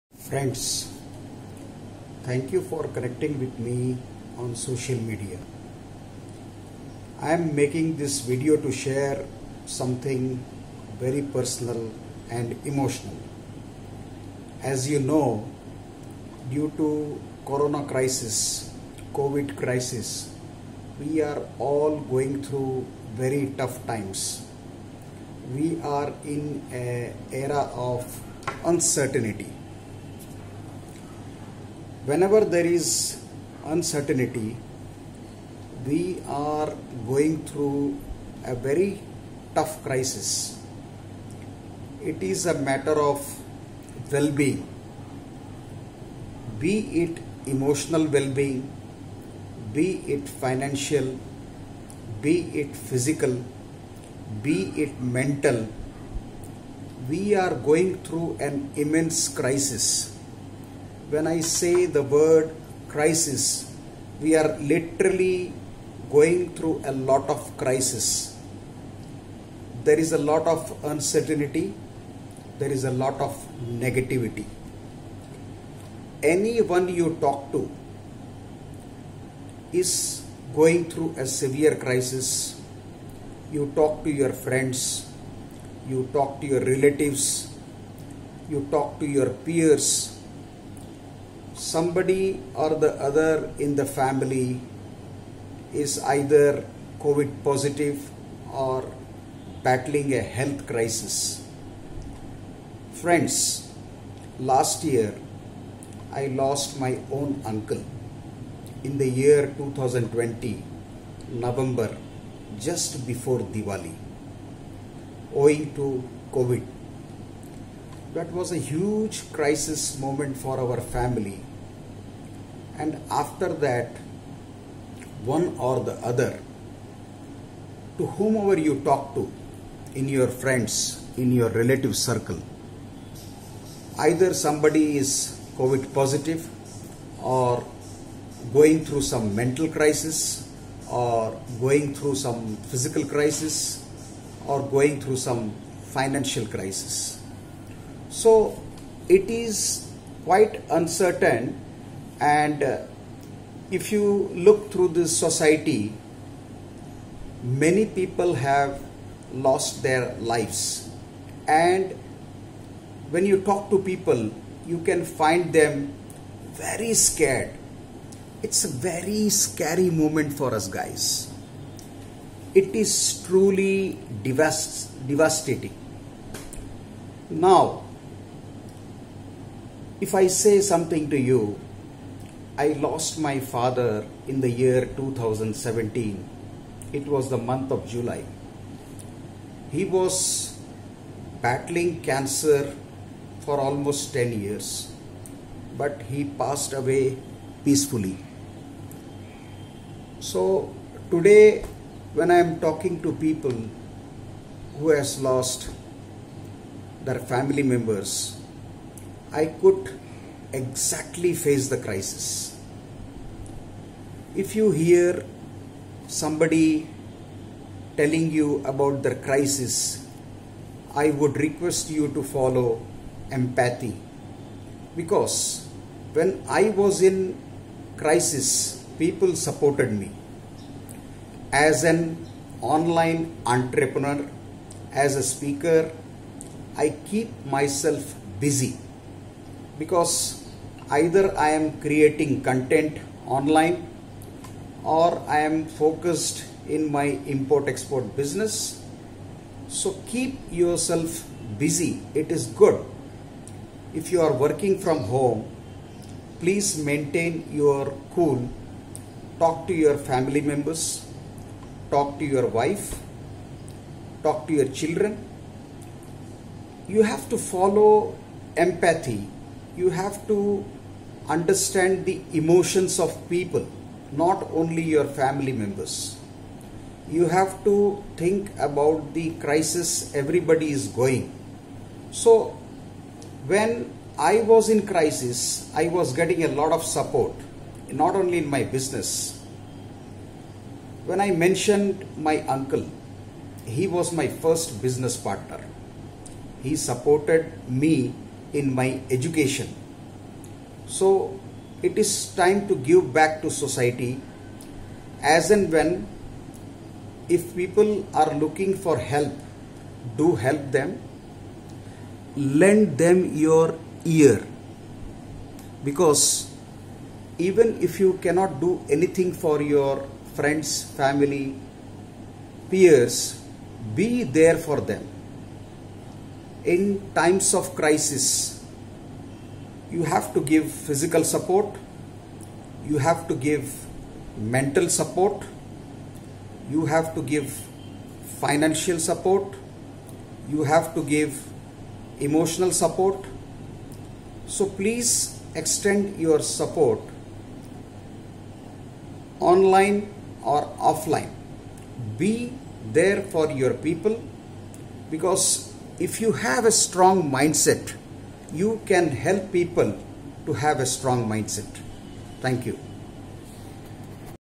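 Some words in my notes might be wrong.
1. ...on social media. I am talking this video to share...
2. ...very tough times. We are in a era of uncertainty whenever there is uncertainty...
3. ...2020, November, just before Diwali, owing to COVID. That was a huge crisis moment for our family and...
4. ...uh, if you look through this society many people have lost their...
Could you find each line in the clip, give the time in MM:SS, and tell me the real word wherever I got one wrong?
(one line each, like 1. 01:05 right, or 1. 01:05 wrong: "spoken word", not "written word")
1. 00:04 wrong: "making", not "talking"
2. 00:23 right
3. 01:49 right
4. 02:32 right.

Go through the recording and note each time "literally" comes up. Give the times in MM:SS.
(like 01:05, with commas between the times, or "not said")
01:04.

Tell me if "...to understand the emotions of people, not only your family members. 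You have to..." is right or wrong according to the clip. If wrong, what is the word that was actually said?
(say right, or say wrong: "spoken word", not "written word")
right.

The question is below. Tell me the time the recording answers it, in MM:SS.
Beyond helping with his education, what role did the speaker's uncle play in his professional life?
04:54.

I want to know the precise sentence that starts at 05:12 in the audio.
Lend them your ear because even if you cannot do anything for your friends, family, peers, be there for them.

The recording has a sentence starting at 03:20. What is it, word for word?
So today, when I am talking to people who has lost their family members, I could exactly face the crisis.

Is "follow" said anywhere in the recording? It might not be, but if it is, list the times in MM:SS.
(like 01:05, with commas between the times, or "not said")
03:42, 04:27.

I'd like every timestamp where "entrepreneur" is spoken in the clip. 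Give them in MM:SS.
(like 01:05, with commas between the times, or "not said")
03:53.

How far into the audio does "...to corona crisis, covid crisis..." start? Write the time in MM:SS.
00:16.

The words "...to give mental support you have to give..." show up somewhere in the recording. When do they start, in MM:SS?
05:33.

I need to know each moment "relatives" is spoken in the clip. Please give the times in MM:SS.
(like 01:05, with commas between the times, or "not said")
01:26, 02:11.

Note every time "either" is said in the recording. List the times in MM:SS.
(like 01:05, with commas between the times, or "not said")
01:36, 02:14, 04:00.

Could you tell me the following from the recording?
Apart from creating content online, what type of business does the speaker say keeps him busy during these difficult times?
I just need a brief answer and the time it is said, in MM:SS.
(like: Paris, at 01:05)
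import export business, at 04:07.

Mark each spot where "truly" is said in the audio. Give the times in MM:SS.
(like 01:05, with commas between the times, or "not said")
02:53.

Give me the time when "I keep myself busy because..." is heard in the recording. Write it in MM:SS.
03:56.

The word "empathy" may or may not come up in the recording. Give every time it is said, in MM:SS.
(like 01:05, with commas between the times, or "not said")
03:43, 04:28.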